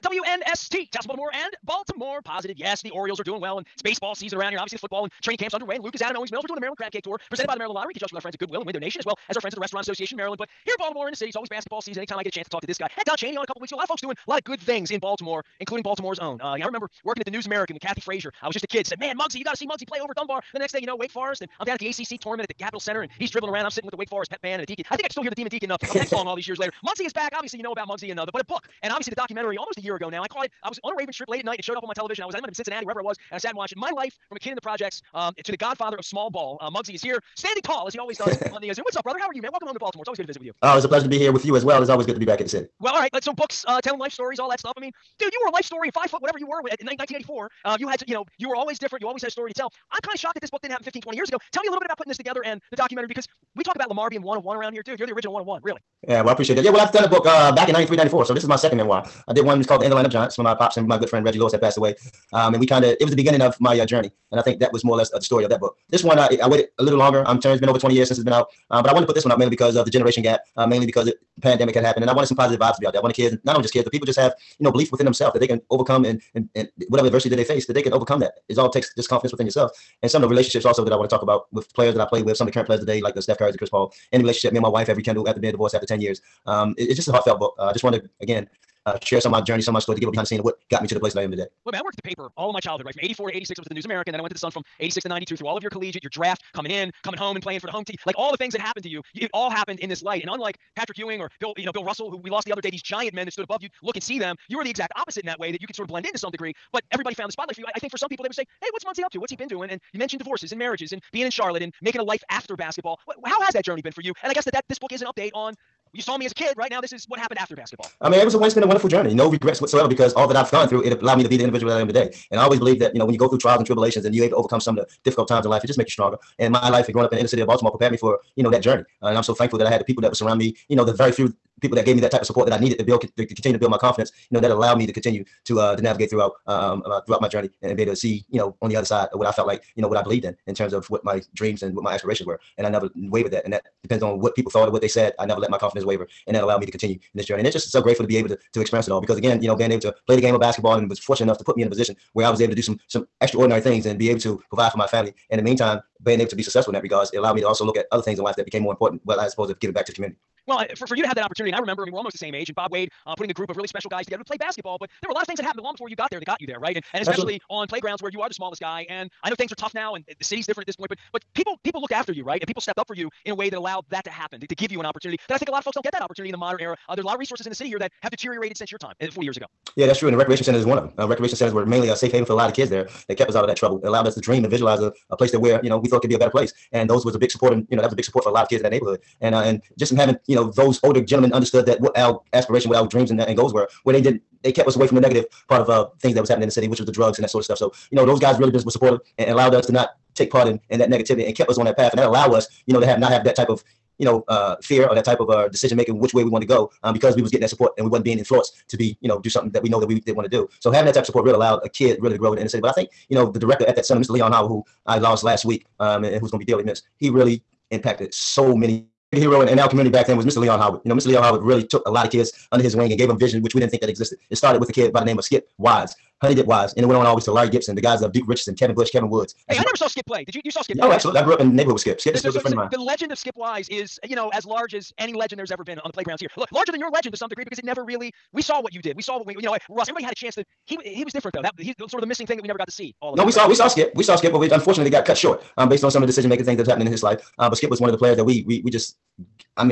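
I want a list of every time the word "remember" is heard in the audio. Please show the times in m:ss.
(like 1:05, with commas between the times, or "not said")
0:16, 2:41.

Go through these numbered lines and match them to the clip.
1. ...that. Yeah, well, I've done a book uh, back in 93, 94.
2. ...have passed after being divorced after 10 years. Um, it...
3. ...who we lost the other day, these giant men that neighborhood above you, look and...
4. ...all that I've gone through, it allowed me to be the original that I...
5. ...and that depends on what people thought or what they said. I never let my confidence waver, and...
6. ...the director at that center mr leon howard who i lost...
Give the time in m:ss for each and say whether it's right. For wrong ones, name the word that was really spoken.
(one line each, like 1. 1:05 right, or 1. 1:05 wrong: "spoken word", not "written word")
1. 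0:56 right
2. 1:24 wrong: "rekindled", not "passed"
3. 1:42 wrong: "stood", not "neighborhood"
4. 2:00 wrong: "individual", not "original"
5. 2:23 right
6. 3:33 right.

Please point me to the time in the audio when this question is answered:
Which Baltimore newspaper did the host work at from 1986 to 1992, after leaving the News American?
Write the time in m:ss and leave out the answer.
1:34.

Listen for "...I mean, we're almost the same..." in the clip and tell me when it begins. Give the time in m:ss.
2:41.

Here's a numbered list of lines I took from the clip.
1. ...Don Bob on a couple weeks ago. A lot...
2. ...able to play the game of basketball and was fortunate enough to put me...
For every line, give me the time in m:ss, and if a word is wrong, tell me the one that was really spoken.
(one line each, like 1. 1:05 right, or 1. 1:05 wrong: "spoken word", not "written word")
1. 0:13 wrong: "Cheney", not "Bob"
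2. 2:29 right.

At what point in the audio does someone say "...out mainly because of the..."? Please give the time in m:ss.
1:09.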